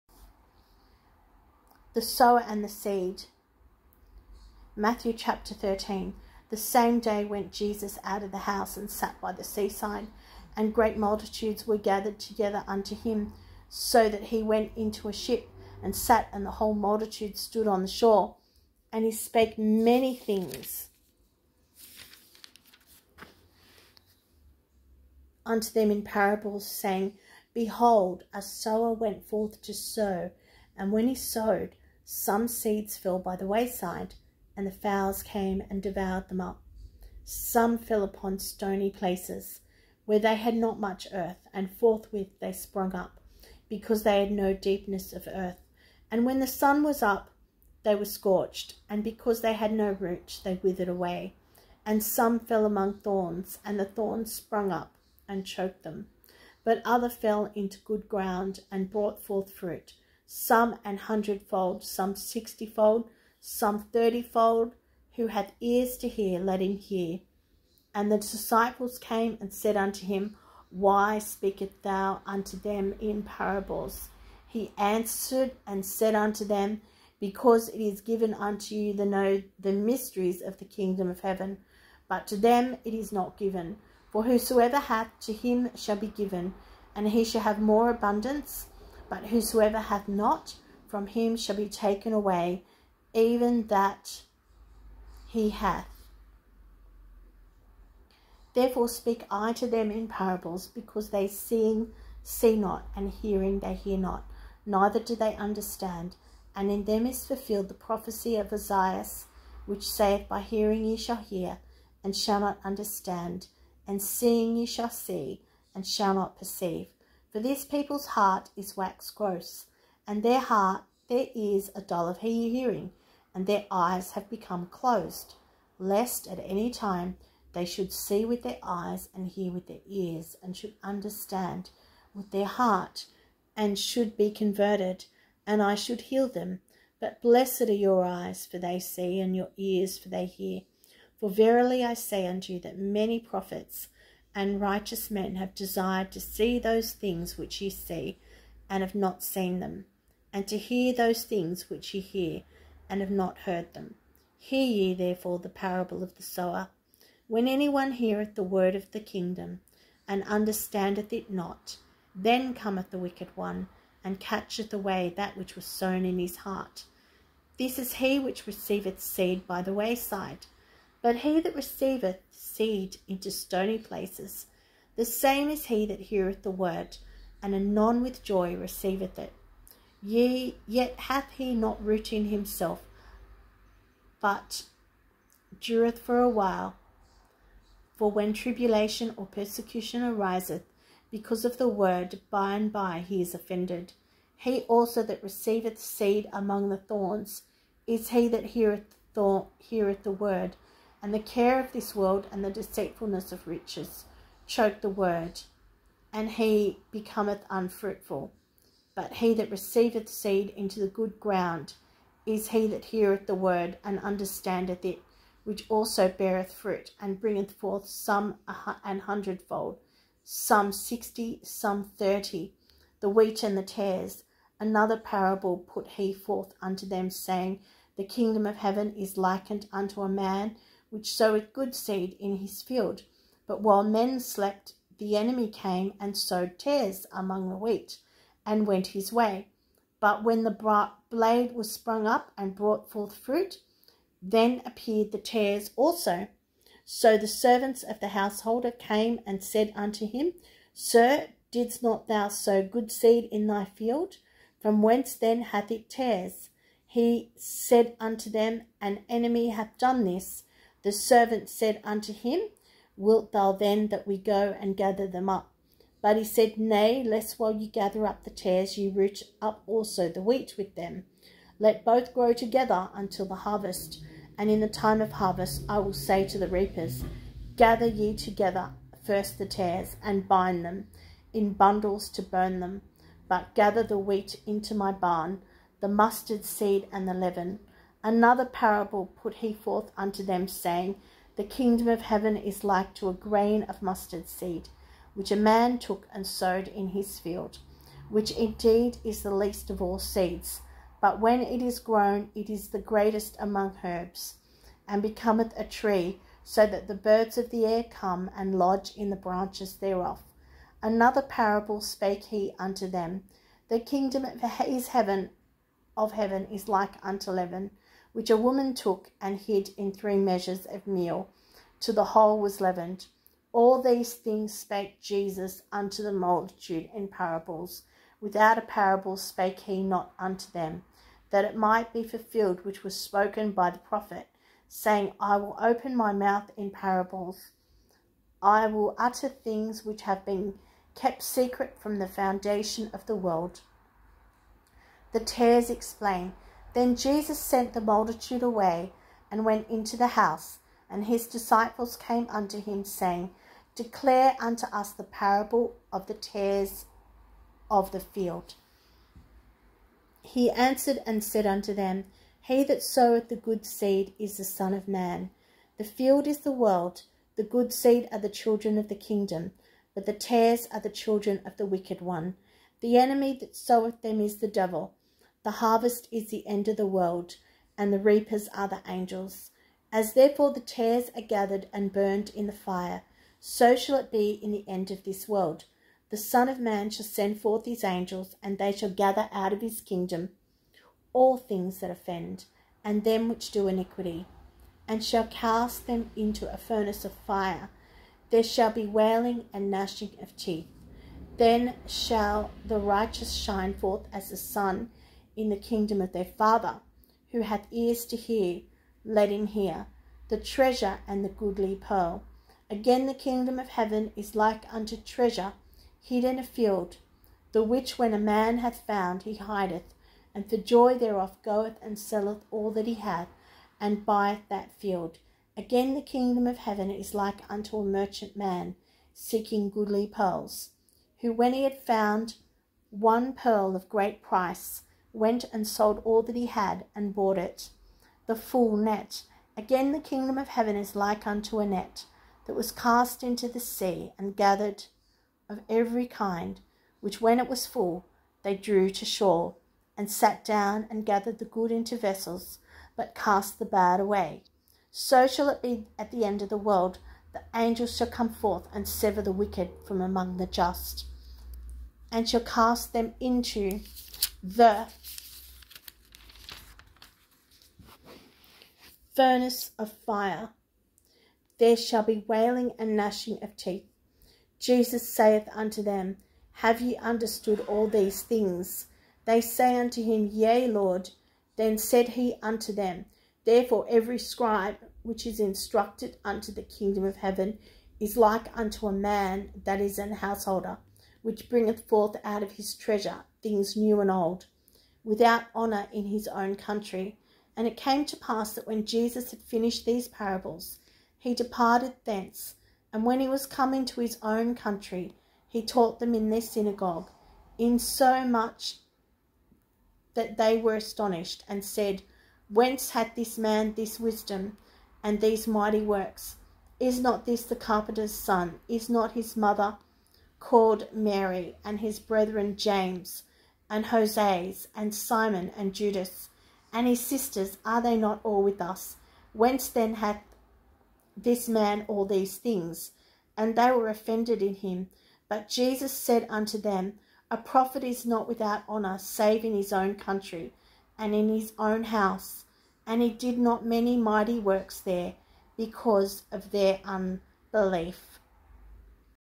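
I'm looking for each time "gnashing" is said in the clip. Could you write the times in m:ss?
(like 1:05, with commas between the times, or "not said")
6:39, 7:52.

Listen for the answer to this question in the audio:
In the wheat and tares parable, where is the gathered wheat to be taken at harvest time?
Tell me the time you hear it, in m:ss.
4:44.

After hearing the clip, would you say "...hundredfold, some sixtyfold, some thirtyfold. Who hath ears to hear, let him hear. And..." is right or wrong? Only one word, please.
right.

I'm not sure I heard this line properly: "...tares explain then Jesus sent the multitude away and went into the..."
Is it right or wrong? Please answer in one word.
right.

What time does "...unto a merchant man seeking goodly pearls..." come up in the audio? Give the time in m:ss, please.
7:07.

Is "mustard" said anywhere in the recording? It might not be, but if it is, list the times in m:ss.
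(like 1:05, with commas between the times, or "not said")
4:45, 4:53.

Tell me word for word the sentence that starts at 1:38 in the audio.
Therefore speak I to them in parables, because they seeing see not, and hearing they hear not, neither do they understand.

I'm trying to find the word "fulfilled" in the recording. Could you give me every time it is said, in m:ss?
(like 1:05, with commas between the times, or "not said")
1:47, 5:32.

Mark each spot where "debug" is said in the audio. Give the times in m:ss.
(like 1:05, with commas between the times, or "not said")
not said.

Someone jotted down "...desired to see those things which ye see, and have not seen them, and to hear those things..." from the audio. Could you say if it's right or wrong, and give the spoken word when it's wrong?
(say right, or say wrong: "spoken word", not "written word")
right.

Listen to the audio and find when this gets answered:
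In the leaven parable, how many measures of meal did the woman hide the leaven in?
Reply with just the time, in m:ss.
5:19.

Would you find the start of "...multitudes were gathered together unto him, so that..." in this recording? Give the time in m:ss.
0:10.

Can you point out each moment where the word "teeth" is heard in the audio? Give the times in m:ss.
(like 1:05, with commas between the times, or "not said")
6:40, 7:53.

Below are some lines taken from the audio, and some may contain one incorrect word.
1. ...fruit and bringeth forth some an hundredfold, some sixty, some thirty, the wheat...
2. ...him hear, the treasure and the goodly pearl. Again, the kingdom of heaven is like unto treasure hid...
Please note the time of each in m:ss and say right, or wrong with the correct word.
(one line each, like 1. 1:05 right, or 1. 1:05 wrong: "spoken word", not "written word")
1. 3:36 right
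2. 6:49 right.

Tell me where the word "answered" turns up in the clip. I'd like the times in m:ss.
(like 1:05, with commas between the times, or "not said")
1:14, 6:00.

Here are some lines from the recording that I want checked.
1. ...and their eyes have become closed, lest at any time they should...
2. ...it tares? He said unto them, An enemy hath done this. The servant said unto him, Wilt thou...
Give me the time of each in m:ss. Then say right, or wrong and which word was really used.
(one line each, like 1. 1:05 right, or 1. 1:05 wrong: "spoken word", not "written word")
1. 2:03 right
2. 4:15 right.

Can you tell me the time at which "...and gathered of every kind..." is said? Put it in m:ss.
7:24.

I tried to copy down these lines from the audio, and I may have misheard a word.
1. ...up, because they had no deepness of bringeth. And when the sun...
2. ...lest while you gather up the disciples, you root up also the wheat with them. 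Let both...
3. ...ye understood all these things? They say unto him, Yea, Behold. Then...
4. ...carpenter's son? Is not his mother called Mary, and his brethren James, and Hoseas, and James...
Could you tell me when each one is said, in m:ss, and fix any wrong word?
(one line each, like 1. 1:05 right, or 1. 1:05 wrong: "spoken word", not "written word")
1. 0:42 wrong: "earth", not "bringeth"
2. 4:27 wrong: "tares", not "disciples"
3. 7:56 wrong: "Lord", not "Behold"
4. 8:37 wrong: "Simon", not "James".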